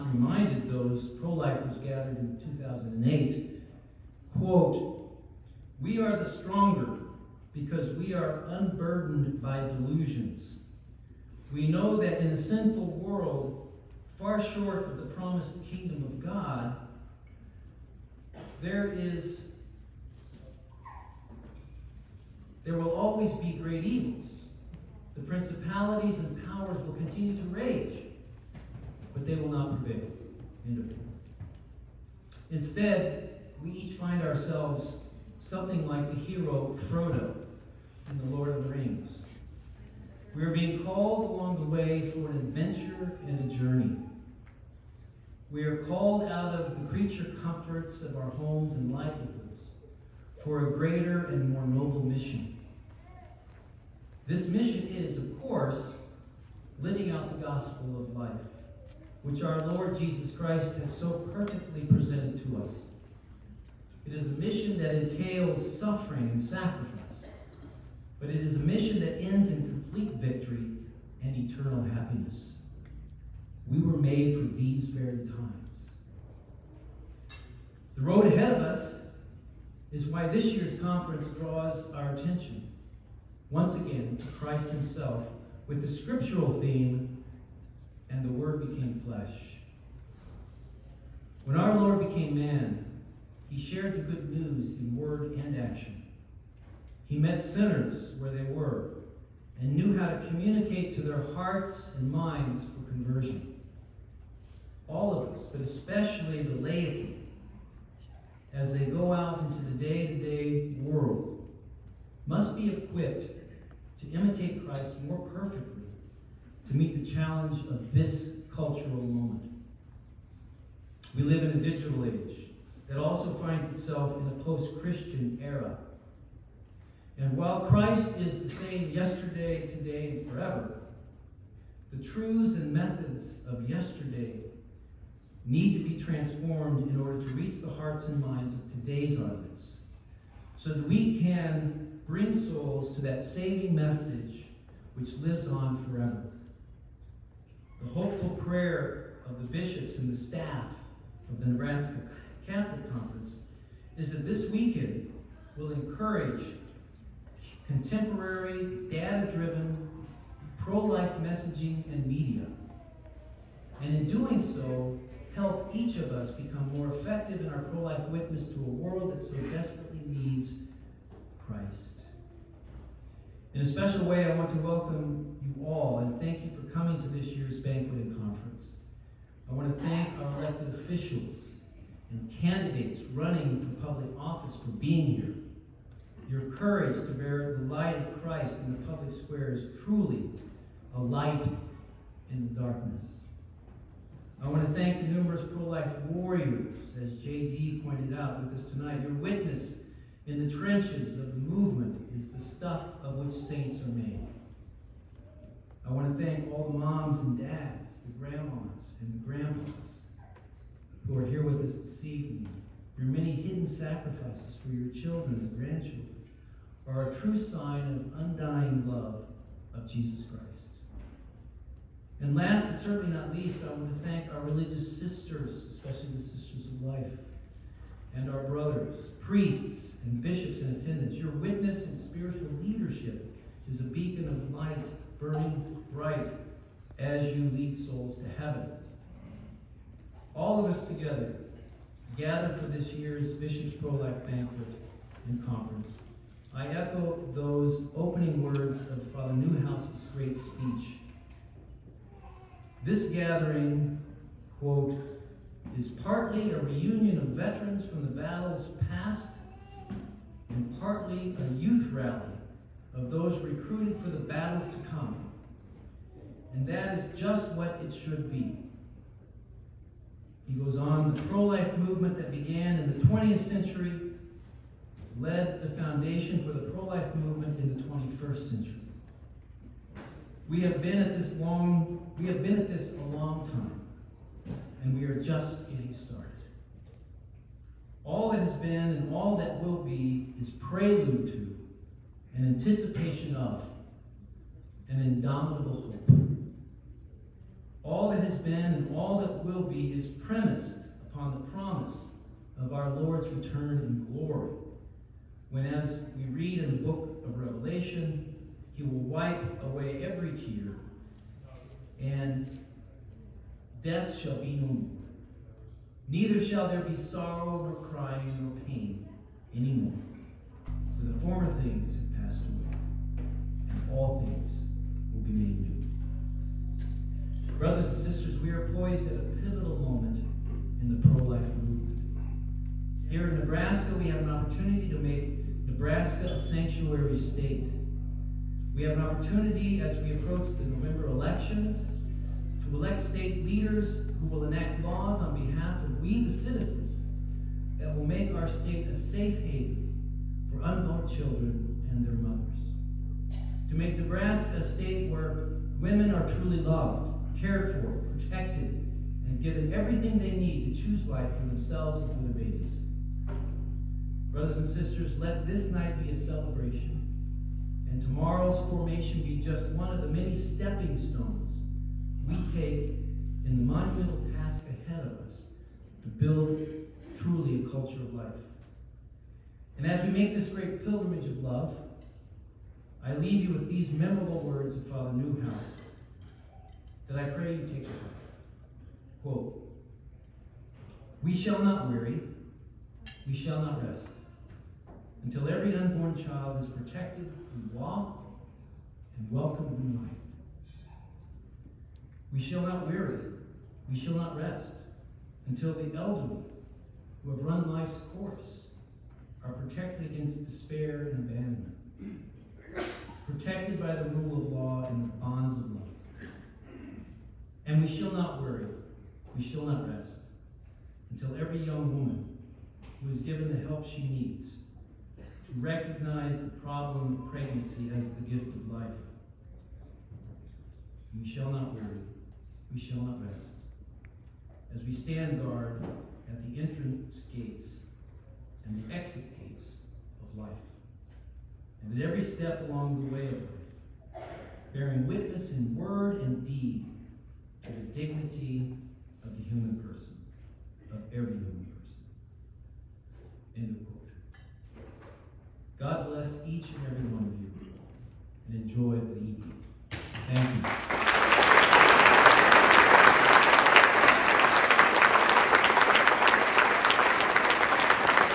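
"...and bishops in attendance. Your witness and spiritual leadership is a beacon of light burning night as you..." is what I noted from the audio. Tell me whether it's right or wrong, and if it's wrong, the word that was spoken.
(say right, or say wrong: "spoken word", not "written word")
wrong: "bright", not "night".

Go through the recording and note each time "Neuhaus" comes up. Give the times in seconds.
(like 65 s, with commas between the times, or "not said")
249 s, 385 s.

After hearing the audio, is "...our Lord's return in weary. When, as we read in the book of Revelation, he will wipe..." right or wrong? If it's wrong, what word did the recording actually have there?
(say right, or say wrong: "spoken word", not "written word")
wrong: "glory", not "weary".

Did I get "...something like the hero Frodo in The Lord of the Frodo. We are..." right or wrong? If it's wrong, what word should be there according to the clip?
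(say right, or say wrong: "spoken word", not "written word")
wrong: "Rings", not "Frodo".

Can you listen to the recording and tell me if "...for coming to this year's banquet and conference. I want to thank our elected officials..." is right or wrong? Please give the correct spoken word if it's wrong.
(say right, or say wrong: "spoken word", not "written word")
right.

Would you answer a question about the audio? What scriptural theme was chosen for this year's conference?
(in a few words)
And the Word became flesh.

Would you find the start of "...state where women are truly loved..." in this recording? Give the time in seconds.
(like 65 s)
354 s.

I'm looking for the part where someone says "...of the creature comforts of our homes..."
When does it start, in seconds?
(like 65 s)
46 s.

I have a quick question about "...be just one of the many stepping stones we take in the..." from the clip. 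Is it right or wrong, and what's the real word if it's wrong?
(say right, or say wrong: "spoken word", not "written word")
right.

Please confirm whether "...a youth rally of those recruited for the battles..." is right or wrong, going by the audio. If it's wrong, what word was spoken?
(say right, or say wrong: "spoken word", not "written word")
right.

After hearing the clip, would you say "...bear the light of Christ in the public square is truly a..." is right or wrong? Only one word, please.
right.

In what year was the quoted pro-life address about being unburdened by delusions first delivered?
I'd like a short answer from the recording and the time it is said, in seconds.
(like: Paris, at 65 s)
2008, at 2 s.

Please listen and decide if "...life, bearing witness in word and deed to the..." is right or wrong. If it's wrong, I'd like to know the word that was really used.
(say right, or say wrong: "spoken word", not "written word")
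right.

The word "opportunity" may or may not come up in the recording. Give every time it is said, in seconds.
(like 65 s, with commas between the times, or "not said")
334 s, 339 s.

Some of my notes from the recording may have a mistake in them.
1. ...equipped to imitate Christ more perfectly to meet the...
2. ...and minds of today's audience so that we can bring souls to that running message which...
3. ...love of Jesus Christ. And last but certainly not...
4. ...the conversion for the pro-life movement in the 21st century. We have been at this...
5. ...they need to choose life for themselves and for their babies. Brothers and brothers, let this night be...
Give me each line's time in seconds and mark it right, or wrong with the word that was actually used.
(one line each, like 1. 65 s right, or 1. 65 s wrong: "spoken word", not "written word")
1. 112 s right
2. 138 s wrong: "saving", not "running"
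3. 218 s right
4. 275 s wrong: "foundation", not "conversion"
5. 360 s wrong: "sisters", not "brothers".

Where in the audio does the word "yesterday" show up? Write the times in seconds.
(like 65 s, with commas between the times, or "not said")
128 s, 133 s.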